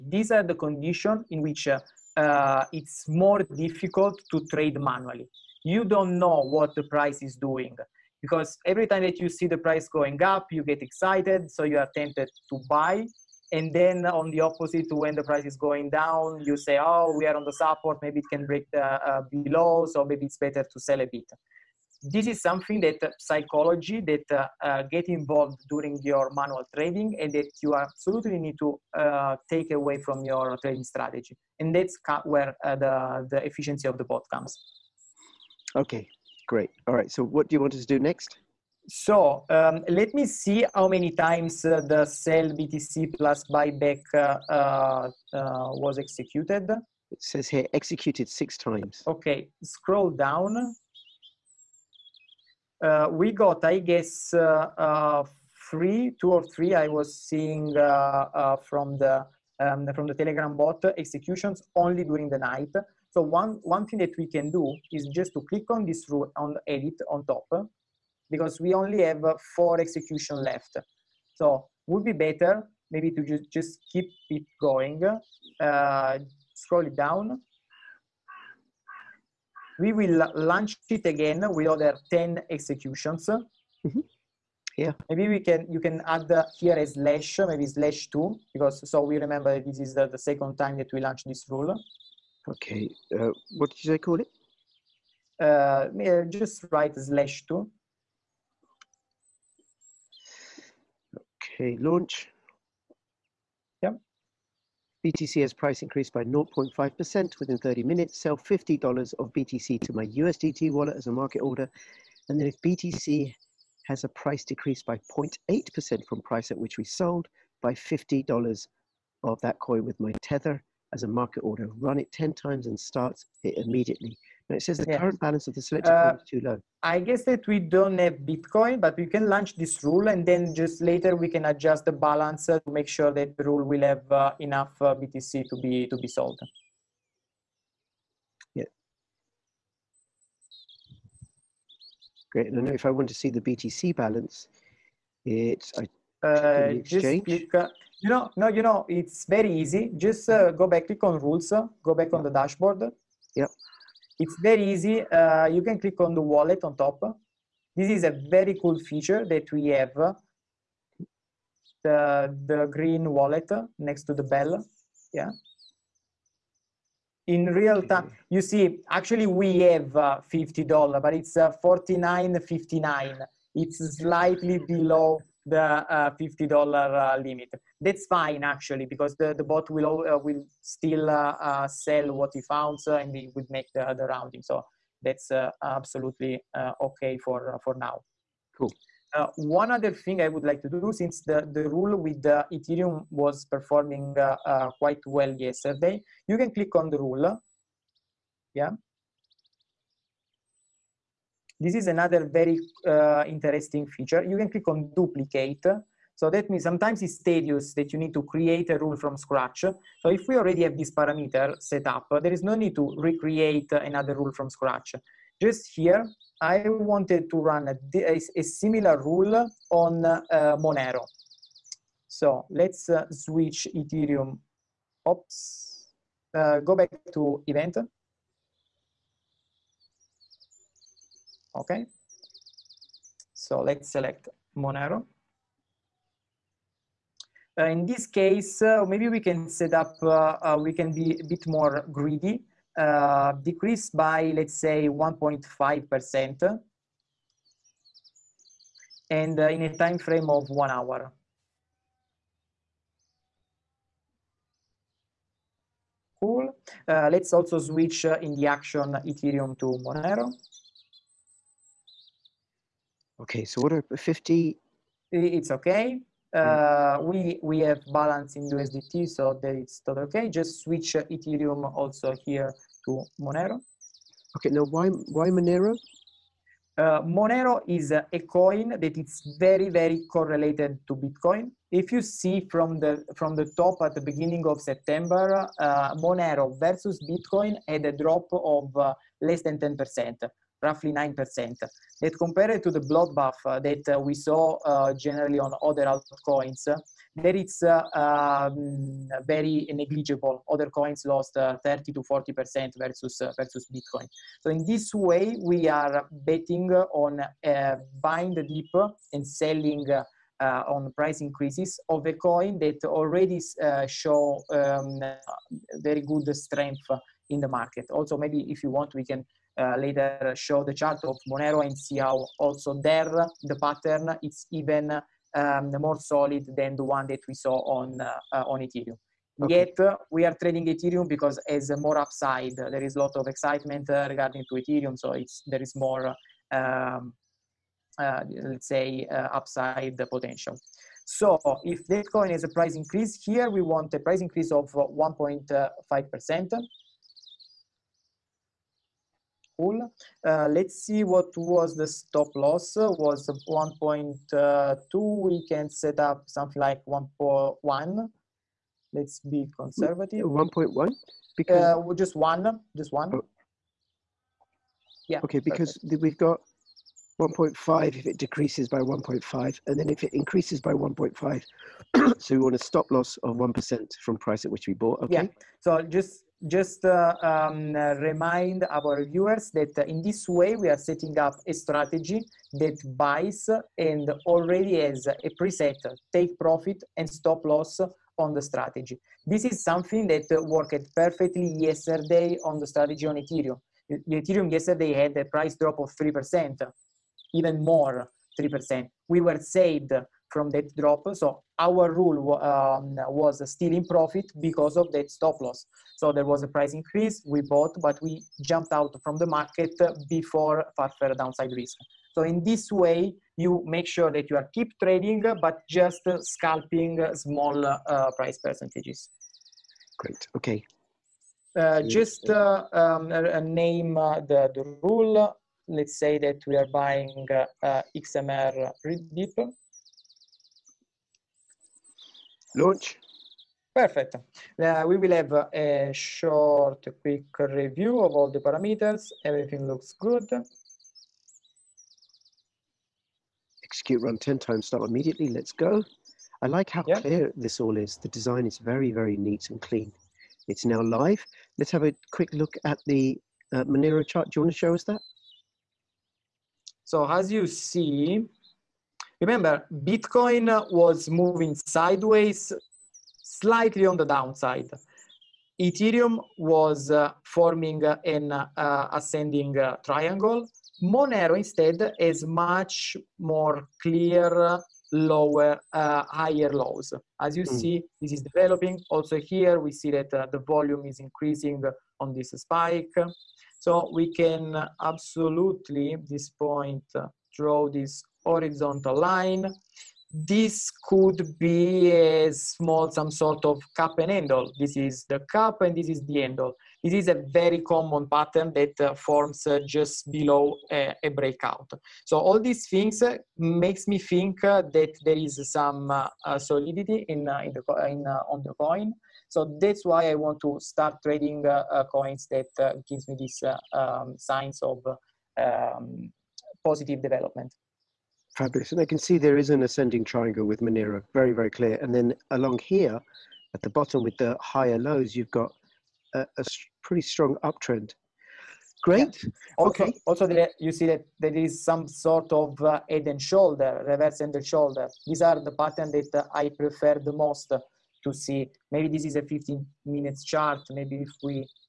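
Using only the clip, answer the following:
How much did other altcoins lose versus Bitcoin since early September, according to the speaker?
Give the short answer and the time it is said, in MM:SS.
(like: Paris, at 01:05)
30 to 40%, at 05:01.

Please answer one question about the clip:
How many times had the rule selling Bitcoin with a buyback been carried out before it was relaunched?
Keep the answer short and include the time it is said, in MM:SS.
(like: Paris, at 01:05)
6, at 00:48.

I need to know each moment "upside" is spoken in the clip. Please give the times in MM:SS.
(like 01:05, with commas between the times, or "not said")
05:31, 05:39.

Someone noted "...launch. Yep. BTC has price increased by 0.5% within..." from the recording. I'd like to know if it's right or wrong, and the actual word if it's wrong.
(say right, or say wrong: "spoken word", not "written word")
right.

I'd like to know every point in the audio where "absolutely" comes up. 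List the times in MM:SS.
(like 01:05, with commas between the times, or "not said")
00:27, 03:05, 08:04.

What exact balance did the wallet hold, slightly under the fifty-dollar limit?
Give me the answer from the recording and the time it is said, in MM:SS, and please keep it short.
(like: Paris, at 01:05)
$49.59, at 02:51.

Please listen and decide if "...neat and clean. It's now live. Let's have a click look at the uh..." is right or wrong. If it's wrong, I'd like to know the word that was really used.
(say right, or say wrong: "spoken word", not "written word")
wrong: "quick", not "click".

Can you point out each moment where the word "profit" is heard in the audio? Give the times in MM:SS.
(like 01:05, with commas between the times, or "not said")
06:26, 06:43.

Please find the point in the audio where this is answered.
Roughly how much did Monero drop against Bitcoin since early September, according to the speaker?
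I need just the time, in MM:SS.
04:50.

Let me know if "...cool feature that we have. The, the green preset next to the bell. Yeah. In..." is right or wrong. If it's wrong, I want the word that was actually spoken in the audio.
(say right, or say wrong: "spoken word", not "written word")
wrong: "wallet", not "preset".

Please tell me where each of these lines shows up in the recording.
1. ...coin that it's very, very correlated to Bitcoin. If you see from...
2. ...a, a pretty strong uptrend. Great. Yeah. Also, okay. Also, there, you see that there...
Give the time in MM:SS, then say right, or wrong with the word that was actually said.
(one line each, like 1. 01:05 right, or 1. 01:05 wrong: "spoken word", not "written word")
1. 04:38 right
2. 08:46 right.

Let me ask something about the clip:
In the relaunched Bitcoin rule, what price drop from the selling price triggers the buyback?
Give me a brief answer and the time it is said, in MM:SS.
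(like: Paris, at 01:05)
0.8%, at 01:54.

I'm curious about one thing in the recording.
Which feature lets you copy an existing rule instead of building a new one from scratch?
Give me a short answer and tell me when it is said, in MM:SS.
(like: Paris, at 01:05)
Duplicate, at 03:24.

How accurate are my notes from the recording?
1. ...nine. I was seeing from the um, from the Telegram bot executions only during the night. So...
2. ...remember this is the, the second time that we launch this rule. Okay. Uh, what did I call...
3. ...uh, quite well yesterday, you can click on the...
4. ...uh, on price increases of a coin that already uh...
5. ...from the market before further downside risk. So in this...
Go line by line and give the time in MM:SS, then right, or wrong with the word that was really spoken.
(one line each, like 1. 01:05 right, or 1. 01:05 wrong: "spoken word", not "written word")
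1. 00:56 wrong: "three", not "nine"
2. 01:29 right
3. 03:14 right
4. 05:10 right
5. 06:49 right.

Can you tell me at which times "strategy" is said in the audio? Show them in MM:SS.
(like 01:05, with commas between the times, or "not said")
00:30, 06:21, 06:28, 06:32.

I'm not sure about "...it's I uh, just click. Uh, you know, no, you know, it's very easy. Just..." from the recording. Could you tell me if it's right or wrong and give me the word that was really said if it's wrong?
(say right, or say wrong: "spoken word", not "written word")
right.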